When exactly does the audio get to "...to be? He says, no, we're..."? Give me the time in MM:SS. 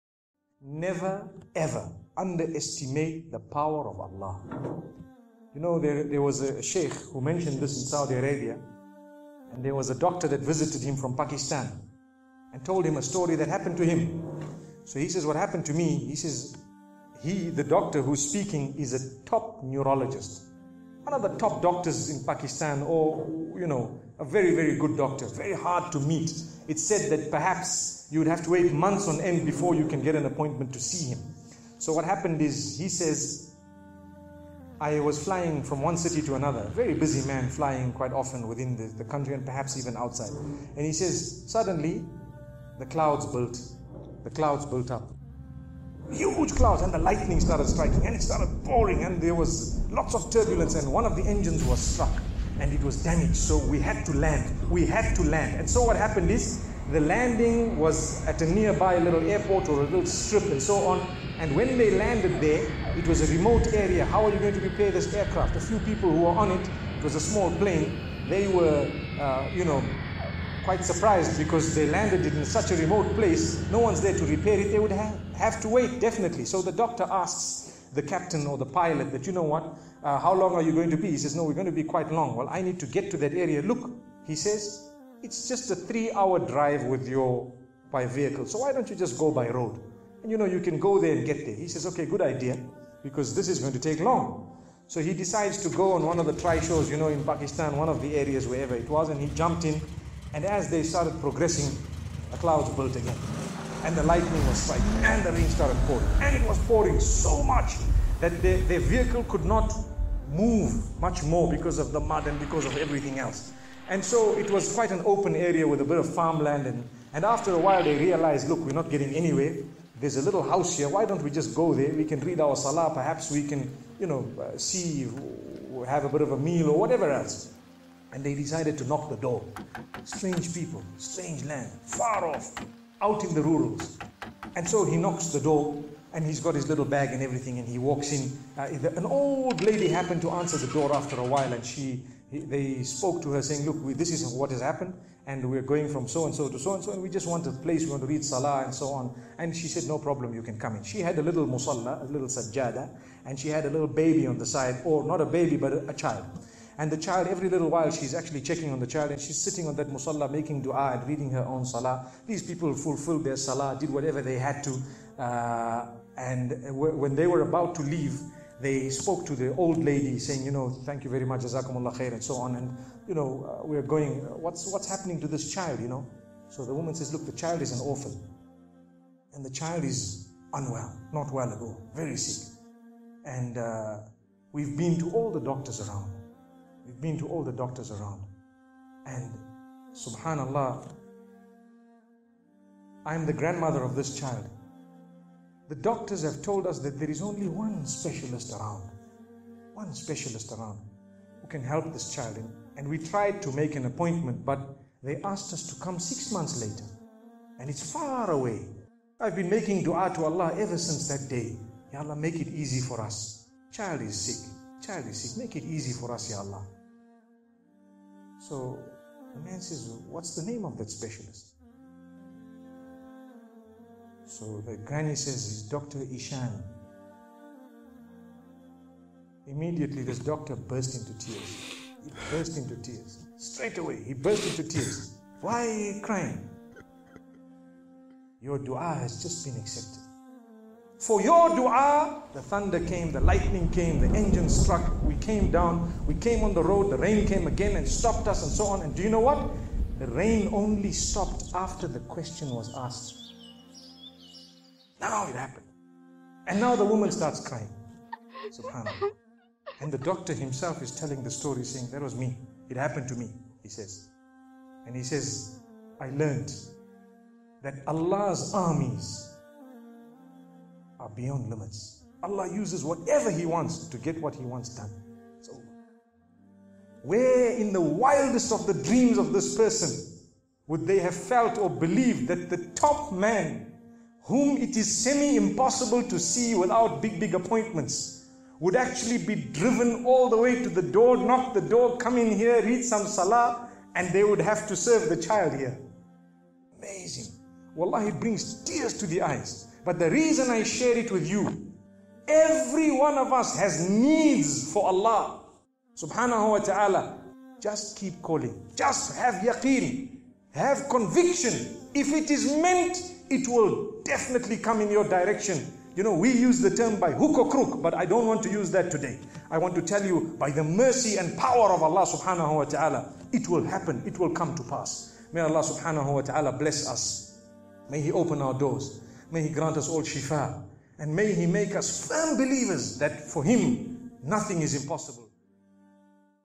01:20.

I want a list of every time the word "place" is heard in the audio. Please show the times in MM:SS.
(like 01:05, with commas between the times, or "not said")
01:13, 02:27.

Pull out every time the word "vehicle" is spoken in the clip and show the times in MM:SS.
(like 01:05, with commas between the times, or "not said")
01:28, 01:48.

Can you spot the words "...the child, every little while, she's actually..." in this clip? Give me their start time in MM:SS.
02:36.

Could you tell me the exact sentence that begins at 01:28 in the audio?
So why don't you just go by road?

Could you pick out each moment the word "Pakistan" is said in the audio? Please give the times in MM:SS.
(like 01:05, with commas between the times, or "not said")
00:11, 00:22, 01:37.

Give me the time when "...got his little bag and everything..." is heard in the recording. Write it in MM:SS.
02:16.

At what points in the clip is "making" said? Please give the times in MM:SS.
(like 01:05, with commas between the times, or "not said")
02:40, 03:29.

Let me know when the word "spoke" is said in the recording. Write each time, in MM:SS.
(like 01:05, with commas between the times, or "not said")
02:22, 02:48.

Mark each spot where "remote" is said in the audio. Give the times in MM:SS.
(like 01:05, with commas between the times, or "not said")
01:03, 01:12.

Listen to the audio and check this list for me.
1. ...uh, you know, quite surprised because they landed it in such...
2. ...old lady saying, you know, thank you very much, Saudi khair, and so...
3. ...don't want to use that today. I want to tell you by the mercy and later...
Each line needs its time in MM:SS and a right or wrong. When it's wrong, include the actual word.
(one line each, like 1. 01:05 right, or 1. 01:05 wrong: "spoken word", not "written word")
1. 01:09 right
2. 02:49 wrong: "Jazakumullah", not "Saudi"
3. 05:18 wrong: "power", not "later".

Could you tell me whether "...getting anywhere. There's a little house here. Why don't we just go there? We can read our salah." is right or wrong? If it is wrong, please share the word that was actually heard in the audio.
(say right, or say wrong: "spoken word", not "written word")
right.